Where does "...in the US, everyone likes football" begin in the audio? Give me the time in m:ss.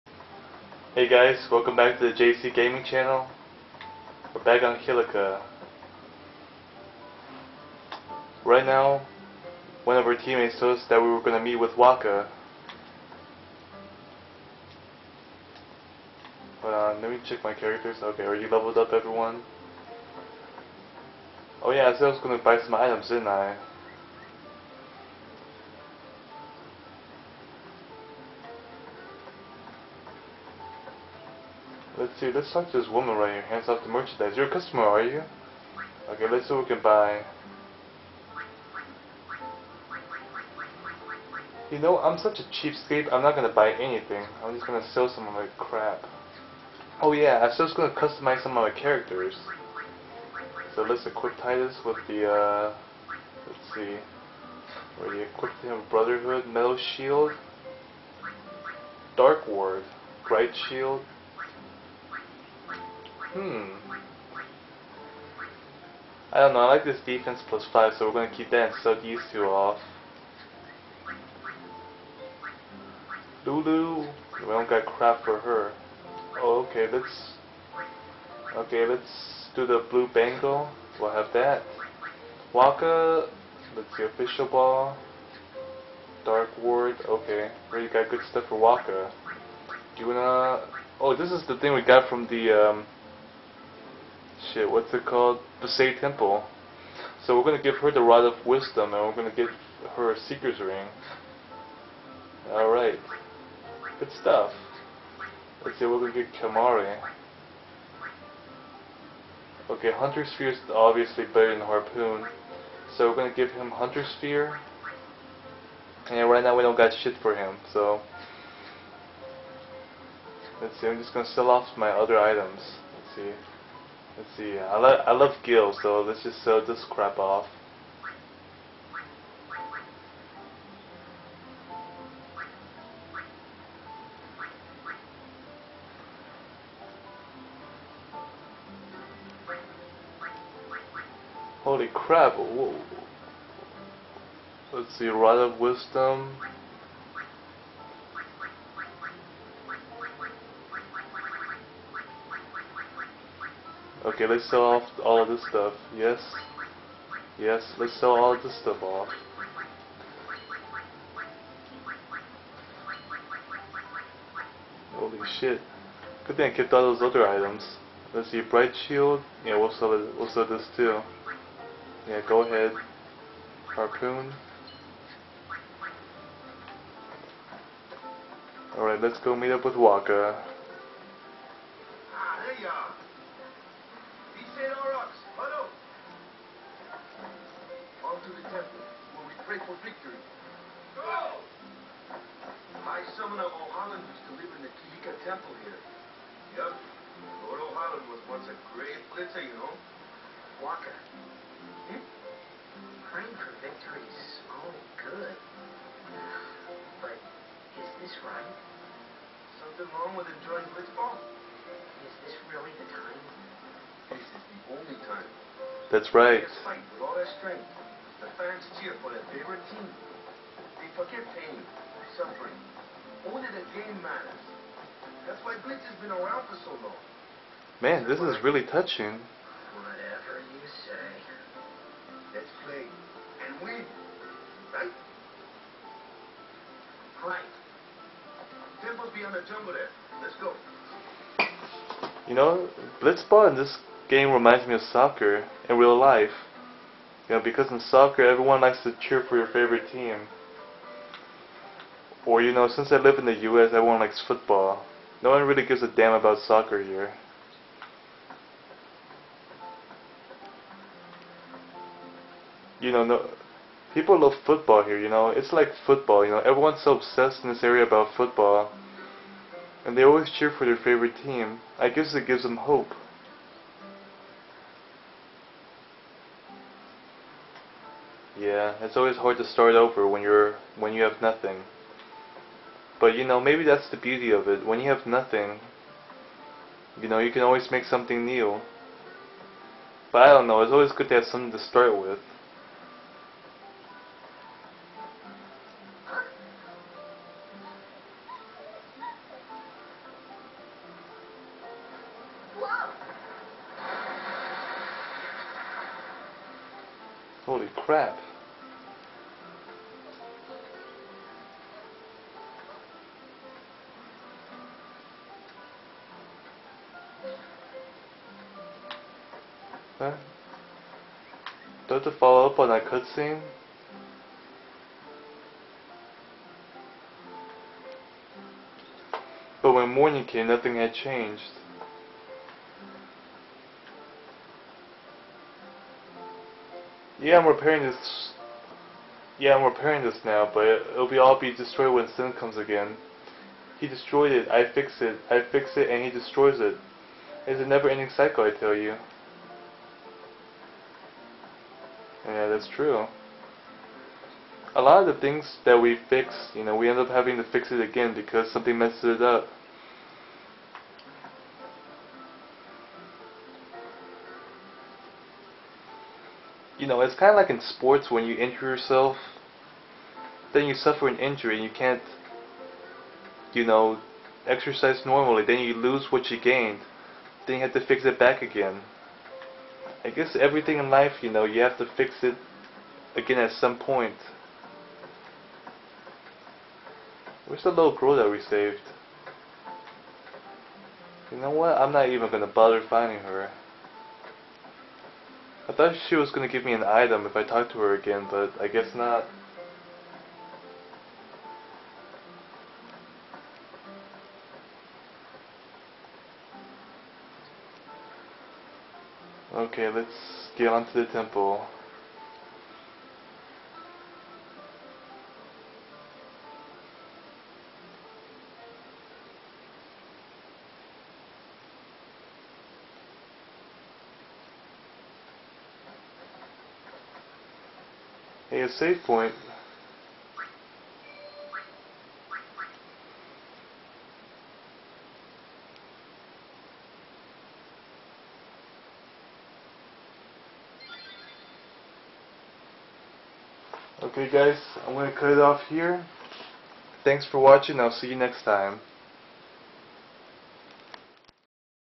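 4:13.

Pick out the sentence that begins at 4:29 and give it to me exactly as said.
And they always cheer for their favorite team.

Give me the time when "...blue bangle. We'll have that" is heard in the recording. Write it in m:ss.
1:19.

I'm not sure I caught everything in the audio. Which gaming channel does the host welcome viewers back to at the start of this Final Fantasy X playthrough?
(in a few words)
JC Gaming.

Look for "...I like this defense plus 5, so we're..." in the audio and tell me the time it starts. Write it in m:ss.
1:06.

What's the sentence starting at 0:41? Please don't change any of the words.
You know, I'm such a cheapskate, I'm not gonna buy anything.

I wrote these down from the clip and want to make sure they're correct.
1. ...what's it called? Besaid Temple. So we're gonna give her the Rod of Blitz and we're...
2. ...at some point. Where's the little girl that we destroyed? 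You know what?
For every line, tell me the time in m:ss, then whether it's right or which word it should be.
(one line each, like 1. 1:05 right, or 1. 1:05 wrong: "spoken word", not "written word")
1. 1:34 wrong: "Wisdom", not "Blitz"
2. 6:23 wrong: "saved", not "destroyed".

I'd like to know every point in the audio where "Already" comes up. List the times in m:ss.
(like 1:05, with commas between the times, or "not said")
1:27.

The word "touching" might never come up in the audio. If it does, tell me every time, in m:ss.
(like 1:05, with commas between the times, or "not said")
3:48.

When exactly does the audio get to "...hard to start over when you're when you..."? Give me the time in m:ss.
4:39.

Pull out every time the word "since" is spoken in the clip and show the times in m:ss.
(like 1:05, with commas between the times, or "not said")
4:12.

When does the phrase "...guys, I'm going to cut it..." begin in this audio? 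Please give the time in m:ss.
7:24.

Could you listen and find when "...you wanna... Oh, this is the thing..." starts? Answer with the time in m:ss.
1:30.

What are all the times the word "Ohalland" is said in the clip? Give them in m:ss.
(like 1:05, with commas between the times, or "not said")
3:13, 3:17.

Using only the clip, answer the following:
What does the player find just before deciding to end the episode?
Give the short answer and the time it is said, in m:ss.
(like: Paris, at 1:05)
a save point, at 7:08.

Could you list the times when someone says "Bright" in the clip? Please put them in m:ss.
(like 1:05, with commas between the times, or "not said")
1:00, 2:48.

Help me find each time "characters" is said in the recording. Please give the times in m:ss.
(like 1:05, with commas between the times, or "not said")
0:17, 0:48.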